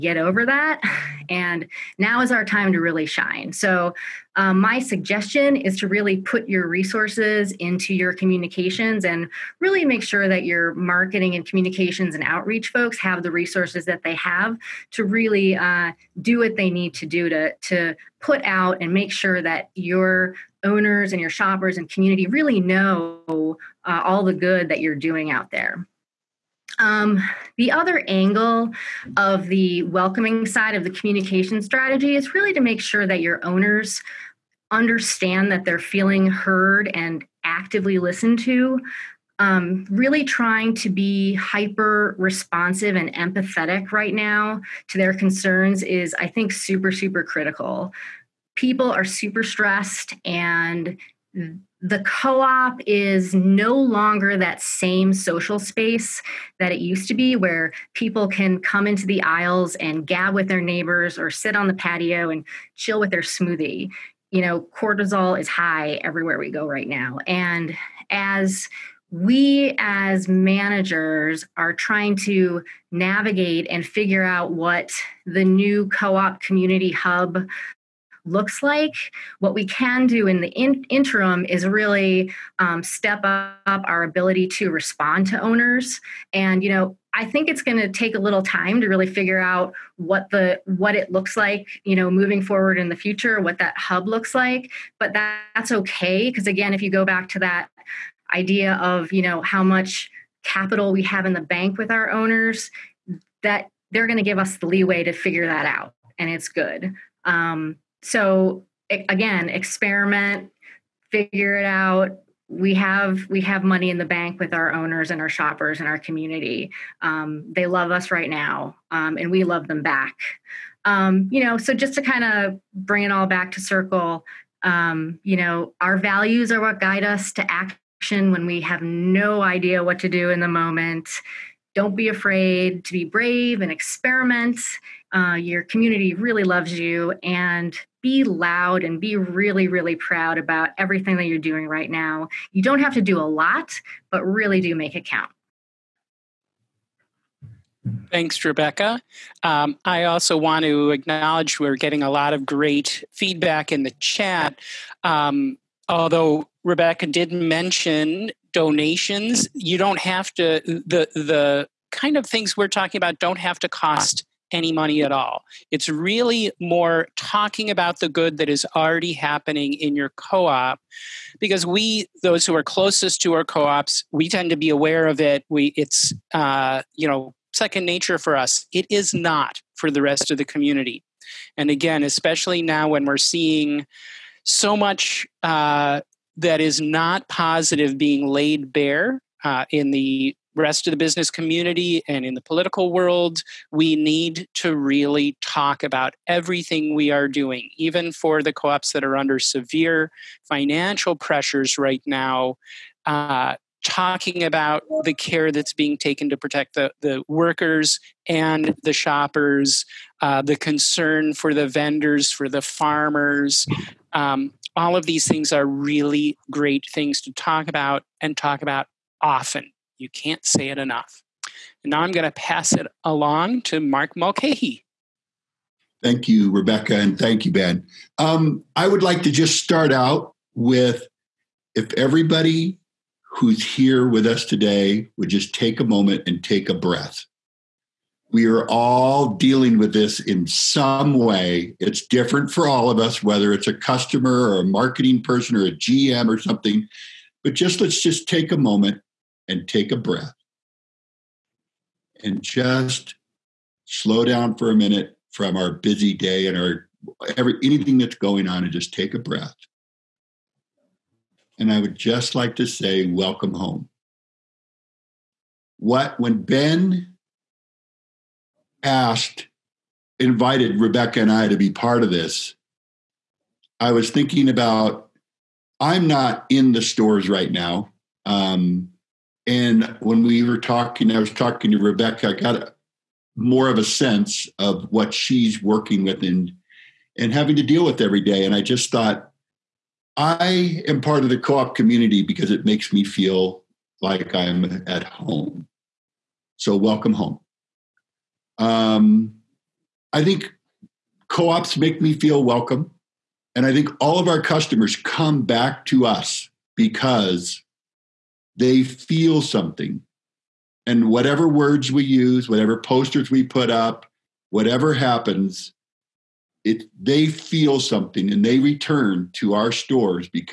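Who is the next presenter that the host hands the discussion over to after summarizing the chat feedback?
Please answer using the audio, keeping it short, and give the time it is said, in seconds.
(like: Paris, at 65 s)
Mark Mulcahy, at 223 s.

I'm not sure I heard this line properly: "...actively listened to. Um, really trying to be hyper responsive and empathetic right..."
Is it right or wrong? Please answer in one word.
right.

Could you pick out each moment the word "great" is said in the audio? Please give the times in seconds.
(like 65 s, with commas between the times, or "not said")
152 s, 216 s.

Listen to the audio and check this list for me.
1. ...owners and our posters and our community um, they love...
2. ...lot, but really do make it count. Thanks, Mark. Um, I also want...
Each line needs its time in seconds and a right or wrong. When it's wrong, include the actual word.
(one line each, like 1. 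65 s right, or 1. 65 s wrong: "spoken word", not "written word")
1. 114 s wrong: "shoppers", not "posters"
2. 143 s wrong: "Rebecca", not "Mark".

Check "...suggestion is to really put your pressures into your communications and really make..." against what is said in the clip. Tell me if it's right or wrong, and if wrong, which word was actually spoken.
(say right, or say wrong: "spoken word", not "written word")
wrong: "resources", not "pressures".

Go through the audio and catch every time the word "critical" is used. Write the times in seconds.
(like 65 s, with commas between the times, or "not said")
47 s.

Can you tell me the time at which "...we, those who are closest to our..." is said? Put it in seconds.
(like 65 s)
171 s.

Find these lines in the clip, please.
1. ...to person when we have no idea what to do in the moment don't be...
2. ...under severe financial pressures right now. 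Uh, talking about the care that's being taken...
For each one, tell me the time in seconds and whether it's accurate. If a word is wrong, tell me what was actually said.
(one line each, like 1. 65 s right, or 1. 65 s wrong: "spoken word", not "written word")
1. 127 s wrong: "action", not "person"
2. 199 s right.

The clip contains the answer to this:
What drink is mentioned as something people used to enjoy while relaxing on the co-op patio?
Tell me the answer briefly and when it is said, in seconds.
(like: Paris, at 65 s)
smoothie, at 63 s.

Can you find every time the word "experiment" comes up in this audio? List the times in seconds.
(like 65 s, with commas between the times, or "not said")
109 s, 133 s.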